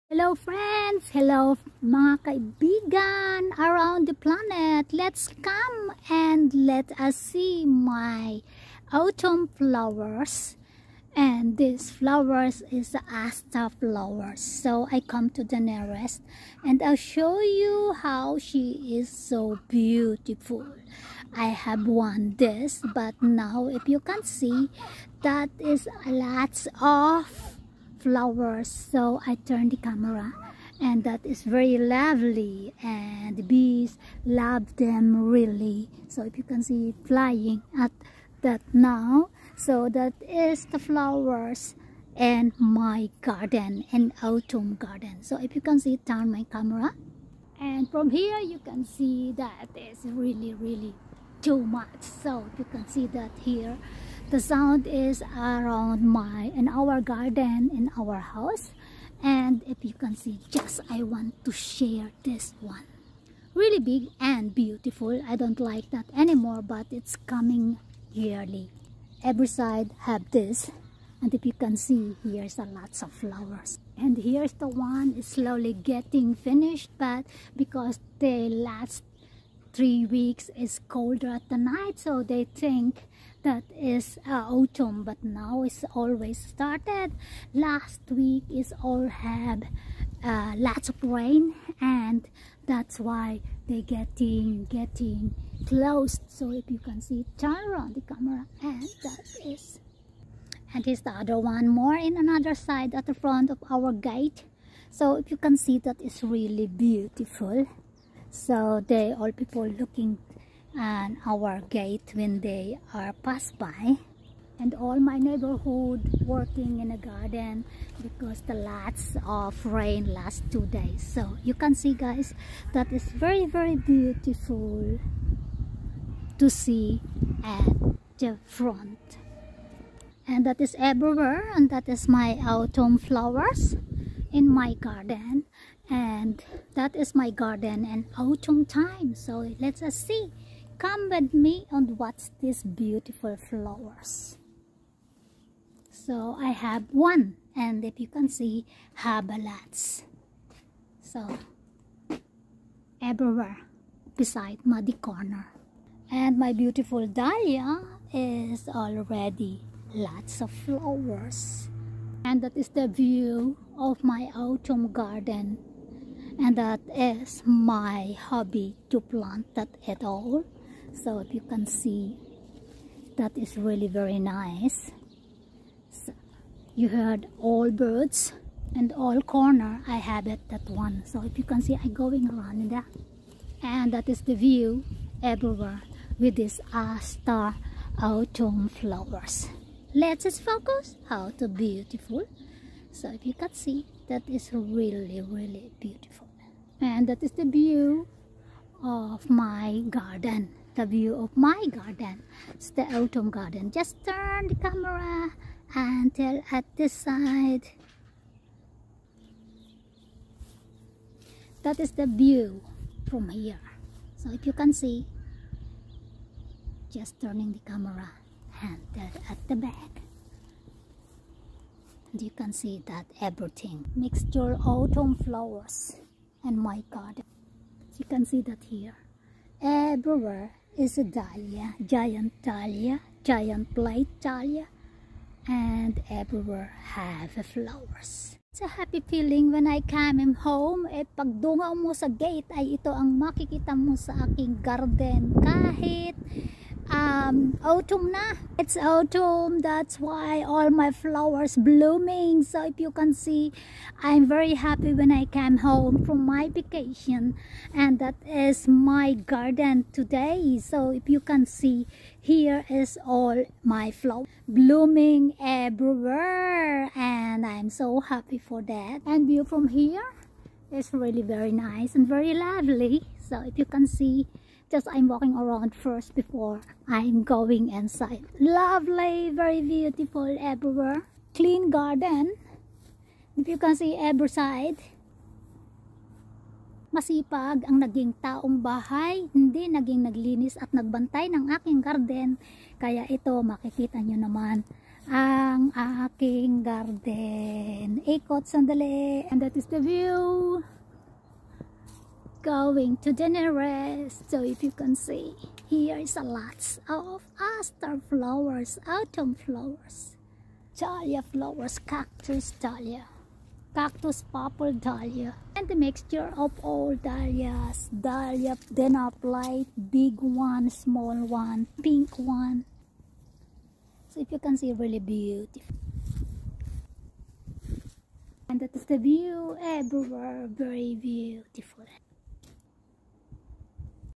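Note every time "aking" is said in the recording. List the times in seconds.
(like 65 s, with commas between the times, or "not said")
244 s, 291 s, 295 s.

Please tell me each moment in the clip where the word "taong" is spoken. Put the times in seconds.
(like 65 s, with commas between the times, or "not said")
288 s.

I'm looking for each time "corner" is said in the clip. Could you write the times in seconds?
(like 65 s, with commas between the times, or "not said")
154 s, 179 s.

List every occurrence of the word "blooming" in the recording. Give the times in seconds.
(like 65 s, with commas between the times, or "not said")
251 s, 264 s.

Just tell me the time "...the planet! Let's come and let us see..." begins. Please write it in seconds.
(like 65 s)
4 s.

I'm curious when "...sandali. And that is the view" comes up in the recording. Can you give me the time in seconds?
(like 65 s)
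298 s.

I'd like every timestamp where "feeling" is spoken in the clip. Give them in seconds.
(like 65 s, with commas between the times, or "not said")
238 s.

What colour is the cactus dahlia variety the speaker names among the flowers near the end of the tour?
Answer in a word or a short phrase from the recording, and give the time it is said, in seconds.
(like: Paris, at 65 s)
Purple, at 313 s.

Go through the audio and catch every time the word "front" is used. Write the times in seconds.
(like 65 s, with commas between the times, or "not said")
103 s, 128 s.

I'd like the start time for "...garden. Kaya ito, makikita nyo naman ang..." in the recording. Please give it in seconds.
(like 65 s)
291 s.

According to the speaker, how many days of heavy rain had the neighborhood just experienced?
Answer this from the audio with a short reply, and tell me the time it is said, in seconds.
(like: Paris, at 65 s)
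2, at 120 s.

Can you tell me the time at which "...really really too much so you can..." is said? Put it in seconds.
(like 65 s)
50 s.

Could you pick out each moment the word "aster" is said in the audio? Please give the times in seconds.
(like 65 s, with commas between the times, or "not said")
13 s, 307 s.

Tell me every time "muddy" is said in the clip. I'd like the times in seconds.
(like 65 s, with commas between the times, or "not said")
154 s.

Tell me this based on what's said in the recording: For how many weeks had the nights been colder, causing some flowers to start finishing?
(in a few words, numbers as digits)
3.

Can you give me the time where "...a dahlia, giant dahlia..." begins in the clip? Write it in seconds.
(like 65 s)
230 s.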